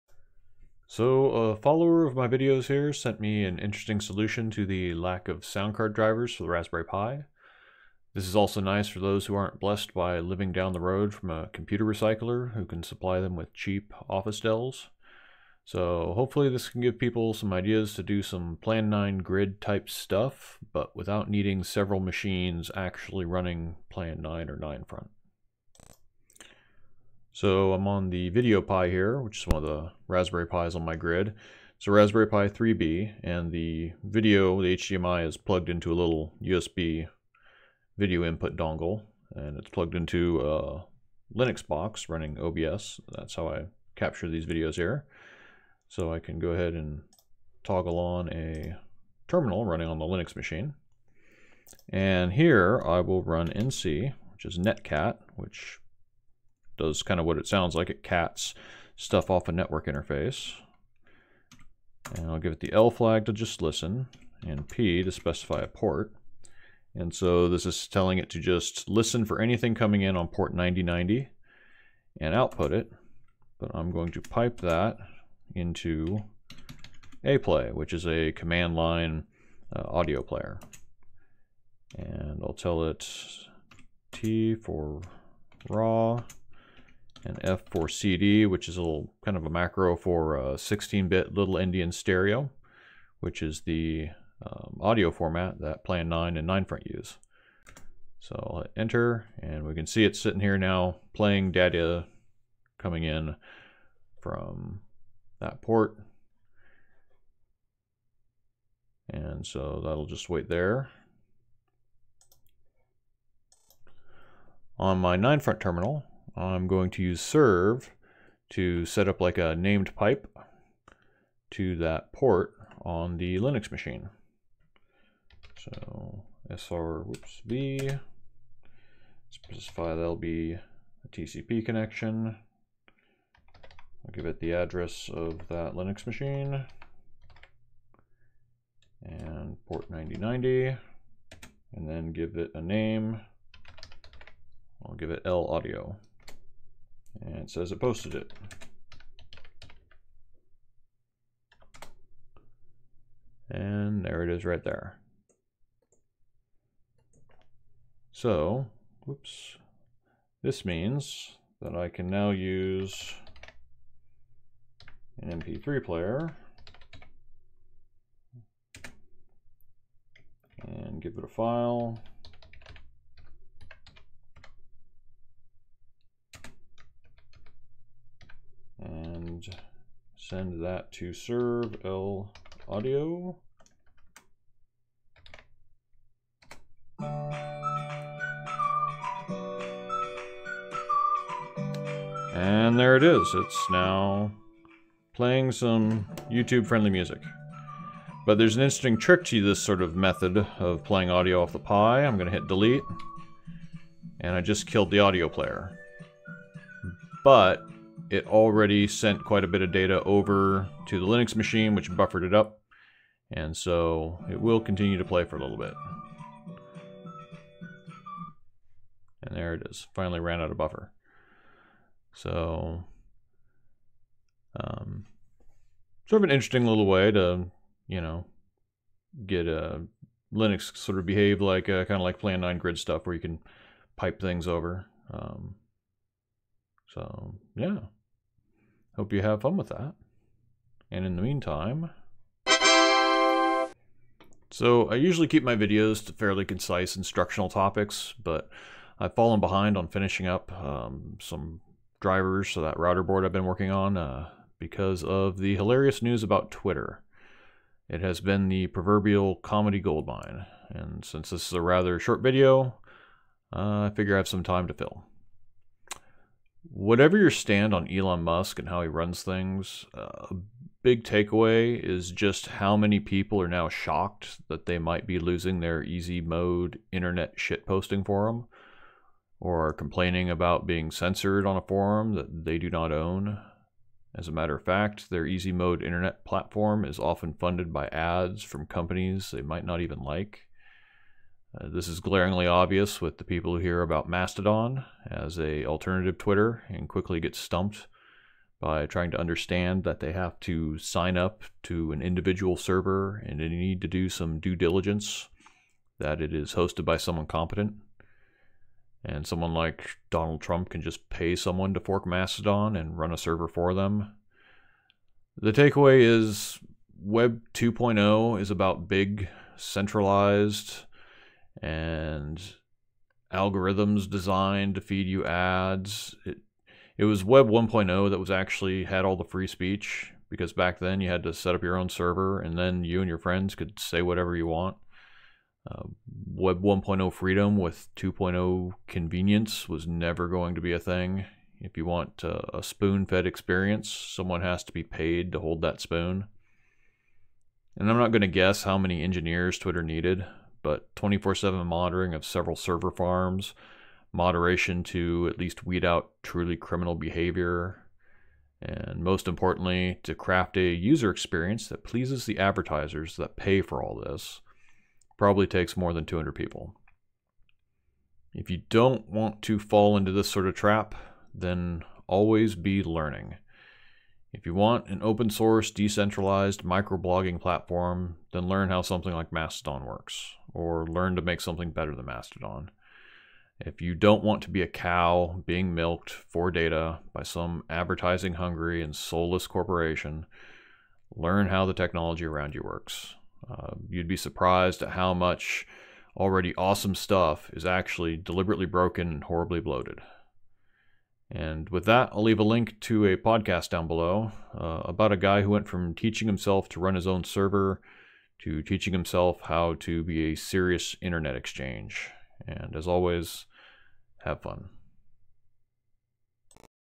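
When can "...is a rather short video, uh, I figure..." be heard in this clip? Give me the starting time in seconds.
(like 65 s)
261 s.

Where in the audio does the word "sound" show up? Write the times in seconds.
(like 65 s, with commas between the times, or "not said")
5 s, 57 s.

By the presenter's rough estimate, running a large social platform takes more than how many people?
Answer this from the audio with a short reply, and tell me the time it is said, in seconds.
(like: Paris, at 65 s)
200, at 366 s.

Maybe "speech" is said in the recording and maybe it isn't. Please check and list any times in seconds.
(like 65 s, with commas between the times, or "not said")
329 s.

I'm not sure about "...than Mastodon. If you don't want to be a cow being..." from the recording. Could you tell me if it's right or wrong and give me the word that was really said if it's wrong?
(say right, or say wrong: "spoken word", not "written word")
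right.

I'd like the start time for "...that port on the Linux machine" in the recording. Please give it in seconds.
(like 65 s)
121 s.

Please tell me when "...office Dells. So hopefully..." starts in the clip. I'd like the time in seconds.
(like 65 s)
14 s.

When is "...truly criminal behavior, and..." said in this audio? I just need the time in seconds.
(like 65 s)
356 s.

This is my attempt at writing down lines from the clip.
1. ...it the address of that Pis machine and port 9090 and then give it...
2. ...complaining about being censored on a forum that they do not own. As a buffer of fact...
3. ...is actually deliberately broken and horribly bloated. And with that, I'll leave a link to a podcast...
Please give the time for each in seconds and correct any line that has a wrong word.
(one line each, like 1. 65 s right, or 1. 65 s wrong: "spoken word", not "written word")
1. 134 s wrong: "Linux", not "Pis"
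2. 279 s wrong: "matter", not "buffer"
3. 397 s right.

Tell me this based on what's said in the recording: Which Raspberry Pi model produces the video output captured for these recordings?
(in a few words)
Raspberry Pi 3B.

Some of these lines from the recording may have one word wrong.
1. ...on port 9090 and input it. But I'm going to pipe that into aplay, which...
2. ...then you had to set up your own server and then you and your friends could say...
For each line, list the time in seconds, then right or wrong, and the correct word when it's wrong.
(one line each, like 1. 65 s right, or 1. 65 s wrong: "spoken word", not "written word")
1. 70 s wrong: "output", not "input"
2. 330 s right.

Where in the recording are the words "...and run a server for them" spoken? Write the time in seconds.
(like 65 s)
312 s.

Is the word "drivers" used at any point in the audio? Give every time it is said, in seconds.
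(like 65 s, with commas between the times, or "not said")
5 s, 252 s.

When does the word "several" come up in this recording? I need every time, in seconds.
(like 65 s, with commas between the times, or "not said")
21 s, 352 s.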